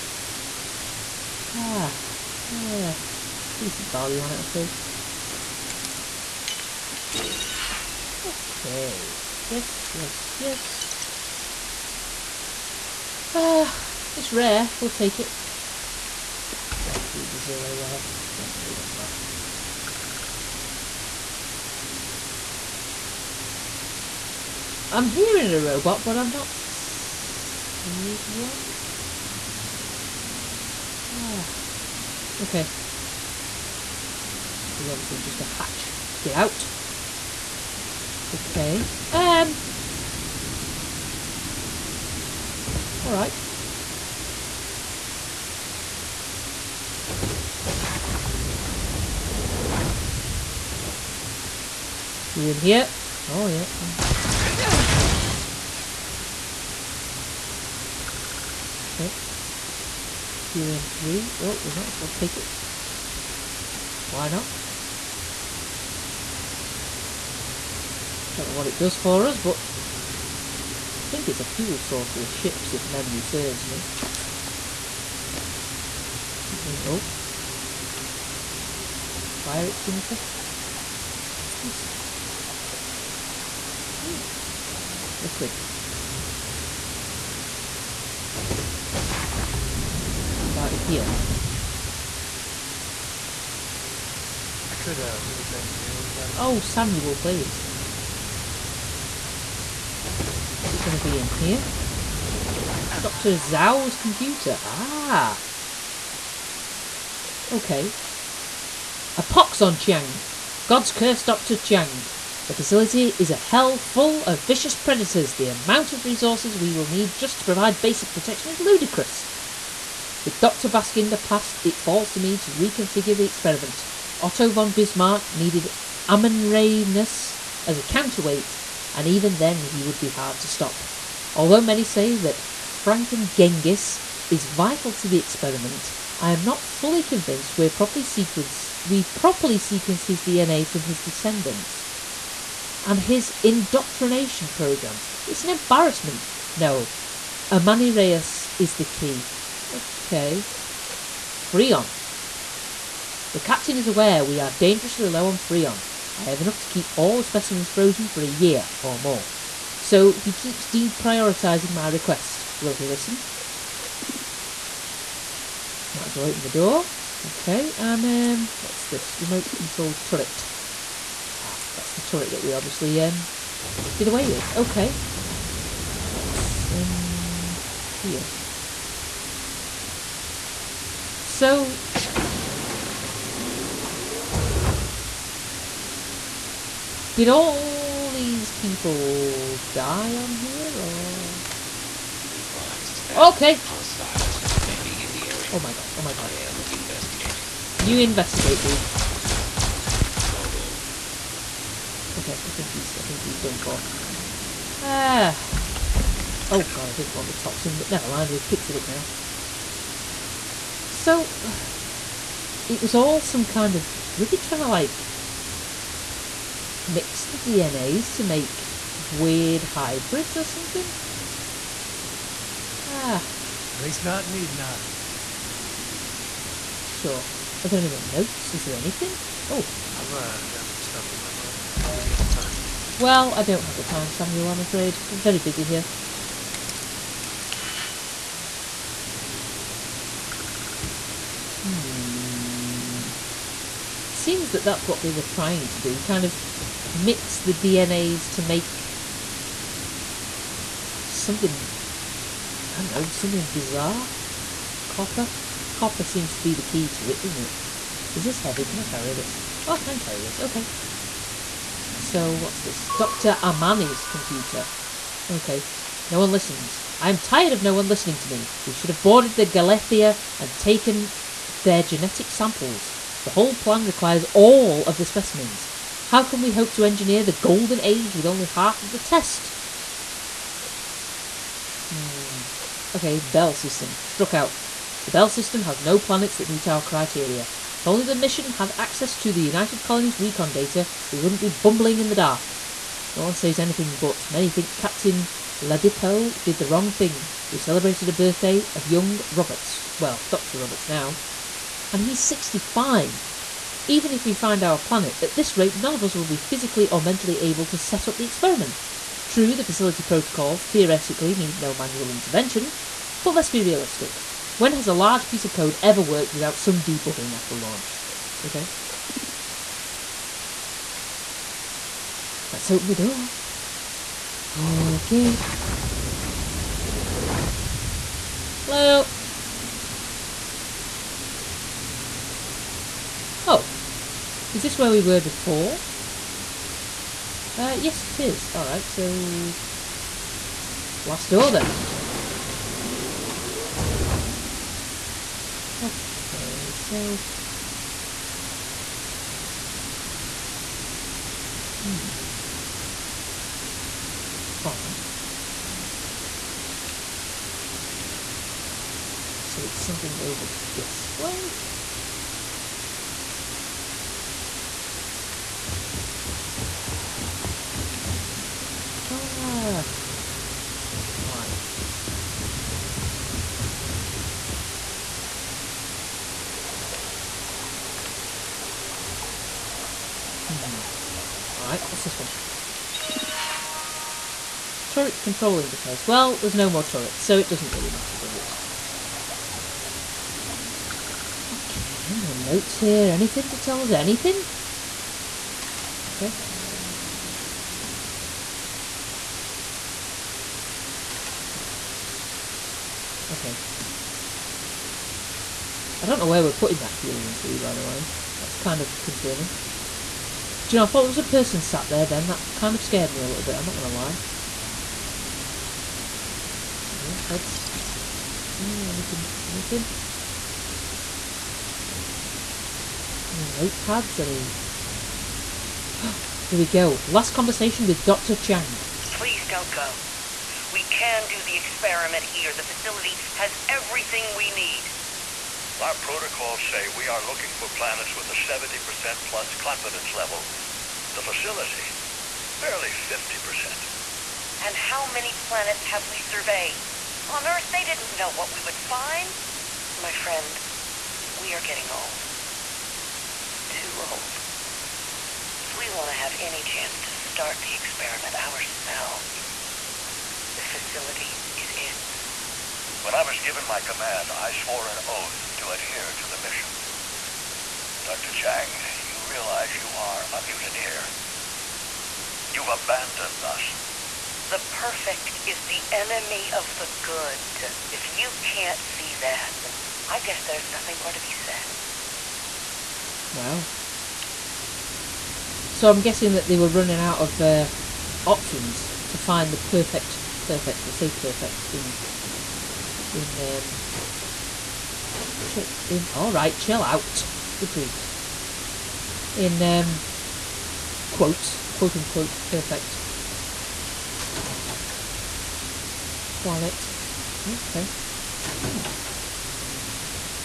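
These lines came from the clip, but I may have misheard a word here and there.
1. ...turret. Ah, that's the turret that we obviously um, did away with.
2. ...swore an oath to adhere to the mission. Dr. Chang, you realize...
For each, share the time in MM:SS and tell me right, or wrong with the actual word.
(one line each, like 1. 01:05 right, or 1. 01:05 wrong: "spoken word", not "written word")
1. 02:50 right
2. 07:44 right.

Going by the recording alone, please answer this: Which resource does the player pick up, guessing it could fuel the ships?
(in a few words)
Helium 3.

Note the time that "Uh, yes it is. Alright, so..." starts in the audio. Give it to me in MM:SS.
05:37.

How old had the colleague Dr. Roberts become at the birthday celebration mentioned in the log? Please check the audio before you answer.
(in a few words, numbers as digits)
65.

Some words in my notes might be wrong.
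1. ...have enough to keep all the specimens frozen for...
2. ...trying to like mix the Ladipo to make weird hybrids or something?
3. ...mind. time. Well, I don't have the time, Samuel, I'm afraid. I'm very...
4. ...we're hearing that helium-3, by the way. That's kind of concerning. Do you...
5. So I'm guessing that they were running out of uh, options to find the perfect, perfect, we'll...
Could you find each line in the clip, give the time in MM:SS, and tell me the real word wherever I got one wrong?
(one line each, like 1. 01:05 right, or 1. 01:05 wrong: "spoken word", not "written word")
1. 02:36 right
2. 03:34 wrong: "DNAs", not "Ladipo"
3. 03:51 right
4. 06:46 wrong: "putting", not "hearing"
5. 08:05 right.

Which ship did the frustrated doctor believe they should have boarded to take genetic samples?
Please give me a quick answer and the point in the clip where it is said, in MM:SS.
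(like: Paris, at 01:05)
Galathea, at 04:29.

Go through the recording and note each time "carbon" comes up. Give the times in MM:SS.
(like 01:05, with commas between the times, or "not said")
not said.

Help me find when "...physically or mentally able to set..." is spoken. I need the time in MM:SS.
05:06.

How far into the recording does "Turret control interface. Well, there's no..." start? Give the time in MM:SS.
06:24.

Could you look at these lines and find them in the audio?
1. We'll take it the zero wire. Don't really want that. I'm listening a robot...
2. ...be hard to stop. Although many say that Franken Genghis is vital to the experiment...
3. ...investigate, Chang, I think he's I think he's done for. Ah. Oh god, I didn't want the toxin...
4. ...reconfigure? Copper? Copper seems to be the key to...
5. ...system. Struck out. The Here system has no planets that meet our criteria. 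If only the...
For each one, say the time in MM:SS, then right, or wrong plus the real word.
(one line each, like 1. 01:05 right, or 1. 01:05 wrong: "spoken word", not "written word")
1. 00:14 wrong: "hearing", not "listening"
2. 02:09 right
3. 03:17 wrong: "Okay", not "Chang"
4. 04:13 wrong: "bizarre", not "reconfigure"
5. 04:43 wrong: "Bell", not "Here".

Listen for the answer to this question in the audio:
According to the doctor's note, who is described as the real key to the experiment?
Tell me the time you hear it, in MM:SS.
02:27.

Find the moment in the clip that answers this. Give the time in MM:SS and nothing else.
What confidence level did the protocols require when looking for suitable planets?
07:18.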